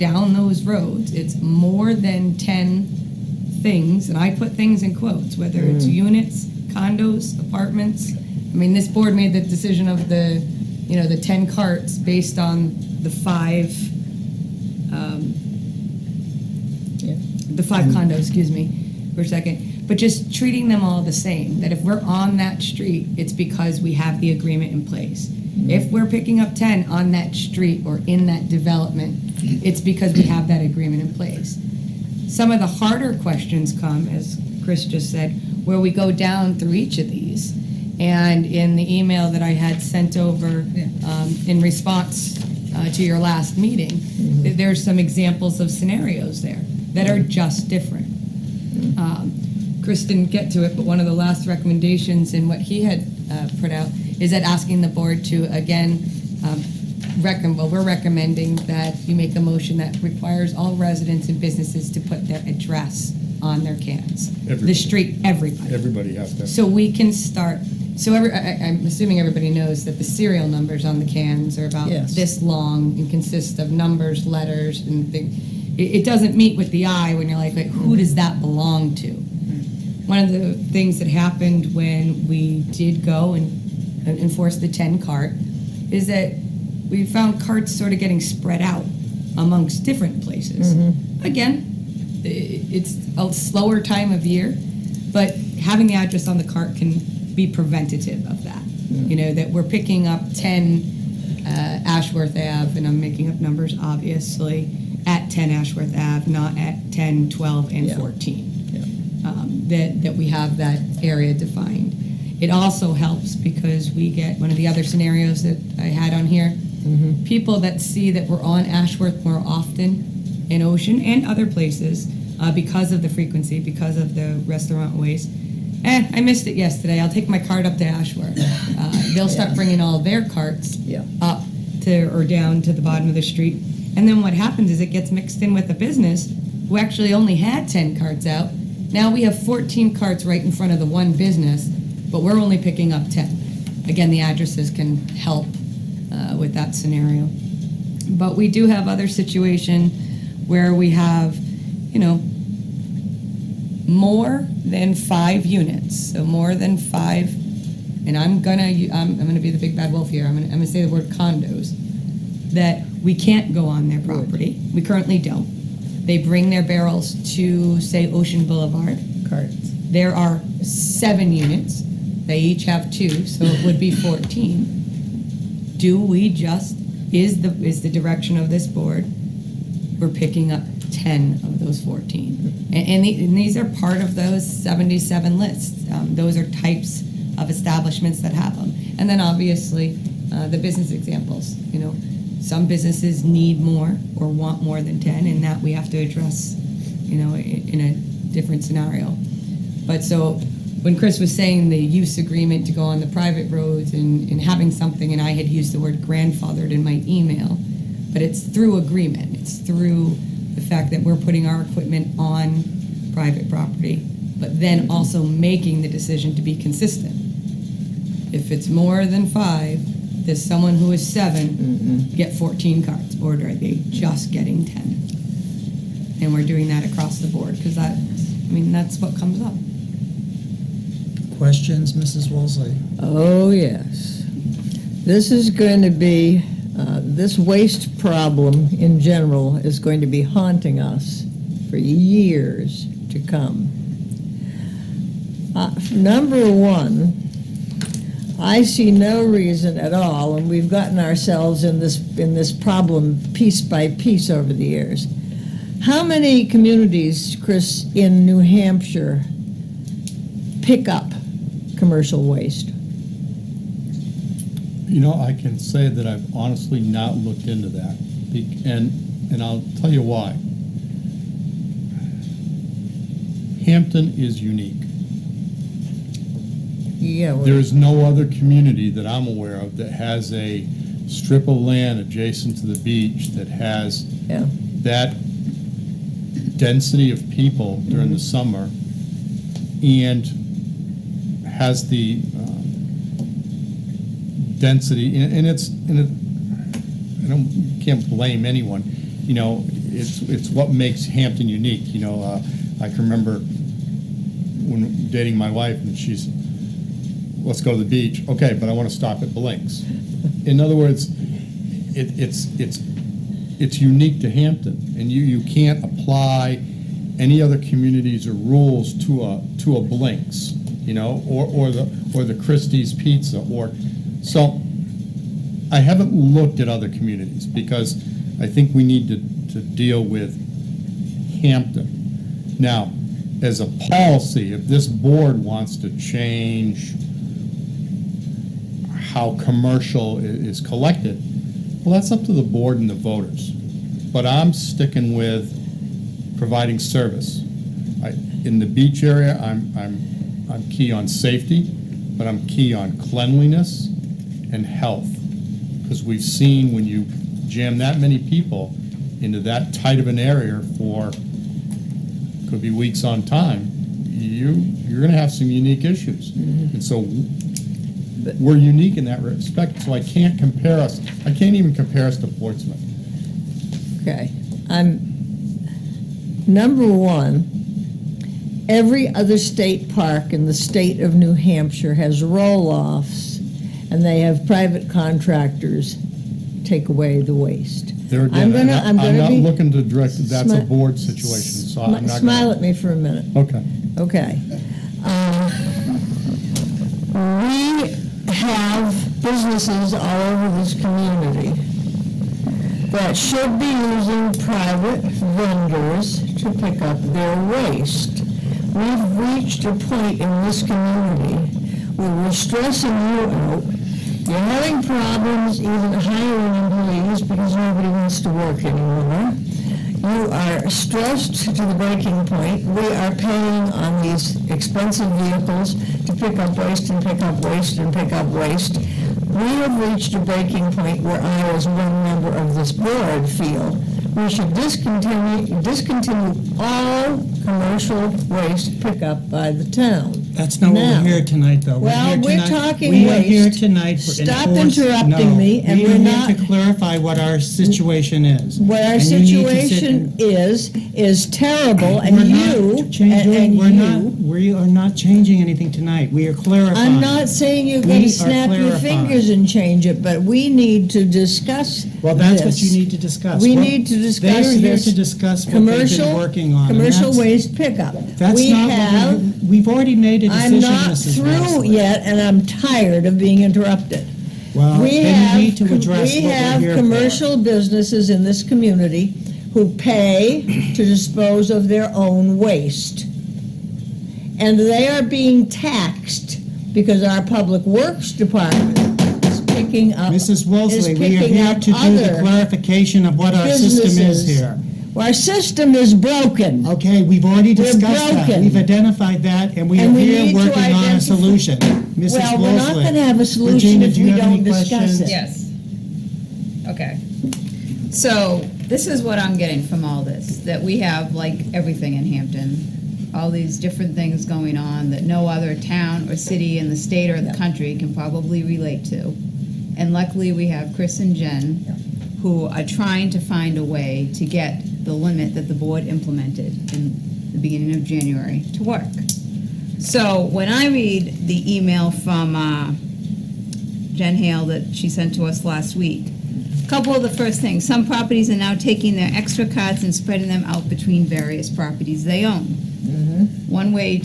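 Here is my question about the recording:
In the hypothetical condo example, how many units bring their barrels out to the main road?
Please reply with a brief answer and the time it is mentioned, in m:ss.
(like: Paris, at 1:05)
7, at 2:49.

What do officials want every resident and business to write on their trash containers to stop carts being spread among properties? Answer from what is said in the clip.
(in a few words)
Their address.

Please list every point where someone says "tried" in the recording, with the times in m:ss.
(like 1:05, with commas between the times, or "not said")
not said.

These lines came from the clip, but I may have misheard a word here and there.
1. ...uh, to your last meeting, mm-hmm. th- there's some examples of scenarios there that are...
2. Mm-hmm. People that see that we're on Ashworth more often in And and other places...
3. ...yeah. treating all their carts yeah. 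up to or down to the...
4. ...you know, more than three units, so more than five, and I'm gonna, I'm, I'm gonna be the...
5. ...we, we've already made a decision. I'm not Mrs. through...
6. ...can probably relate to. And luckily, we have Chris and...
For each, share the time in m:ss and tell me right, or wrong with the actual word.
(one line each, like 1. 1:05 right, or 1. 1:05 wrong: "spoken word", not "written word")
1. 0:42 right
2. 1:56 wrong: "Ocean", not "And"
3. 2:09 wrong: "bringing", not "treating"
4. 2:31 wrong: "five", not "three"
5. 7:49 right
6. 8:37 right.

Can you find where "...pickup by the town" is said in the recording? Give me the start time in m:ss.
7:18.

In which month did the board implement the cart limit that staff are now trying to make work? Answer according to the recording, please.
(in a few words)
January.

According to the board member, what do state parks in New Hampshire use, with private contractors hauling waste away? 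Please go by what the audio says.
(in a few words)
Roll offs.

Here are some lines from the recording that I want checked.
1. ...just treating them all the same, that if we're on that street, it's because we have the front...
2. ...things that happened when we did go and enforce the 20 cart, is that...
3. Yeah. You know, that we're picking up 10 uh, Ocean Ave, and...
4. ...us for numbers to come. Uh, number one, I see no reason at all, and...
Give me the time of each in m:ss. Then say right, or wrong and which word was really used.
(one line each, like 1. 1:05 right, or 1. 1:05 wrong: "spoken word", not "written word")
1. 0:19 wrong: "agreement", not "front"
2. 1:20 wrong: "10", not "20"
3. 1:38 wrong: "Ashworth", not "Ocean"
4. 4:00 wrong: "years", not "numbers".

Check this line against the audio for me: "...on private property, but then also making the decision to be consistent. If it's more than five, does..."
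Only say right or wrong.
right.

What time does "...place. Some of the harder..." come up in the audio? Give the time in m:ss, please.
0:31.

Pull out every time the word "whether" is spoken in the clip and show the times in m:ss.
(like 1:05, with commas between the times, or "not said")
0:05.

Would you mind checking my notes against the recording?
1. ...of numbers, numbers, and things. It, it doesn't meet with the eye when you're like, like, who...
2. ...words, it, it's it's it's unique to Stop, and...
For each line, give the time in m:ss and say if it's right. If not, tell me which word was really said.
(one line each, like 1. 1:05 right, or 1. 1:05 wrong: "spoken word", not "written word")
1. 1:13 wrong: "letters", not "numbers"
2. 5:10 wrong: "Hampton", not "Stop".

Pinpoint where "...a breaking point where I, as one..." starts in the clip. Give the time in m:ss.
7:10.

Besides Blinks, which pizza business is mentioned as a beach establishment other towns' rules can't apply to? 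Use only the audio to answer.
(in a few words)
Christie's Pizza.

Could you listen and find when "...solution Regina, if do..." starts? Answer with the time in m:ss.
8:23.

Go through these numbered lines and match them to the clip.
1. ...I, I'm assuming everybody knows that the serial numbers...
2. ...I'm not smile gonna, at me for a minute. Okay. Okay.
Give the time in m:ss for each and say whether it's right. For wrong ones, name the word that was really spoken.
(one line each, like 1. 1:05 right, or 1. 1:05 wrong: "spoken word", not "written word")
1. 1:08 right
2. 6:31 right.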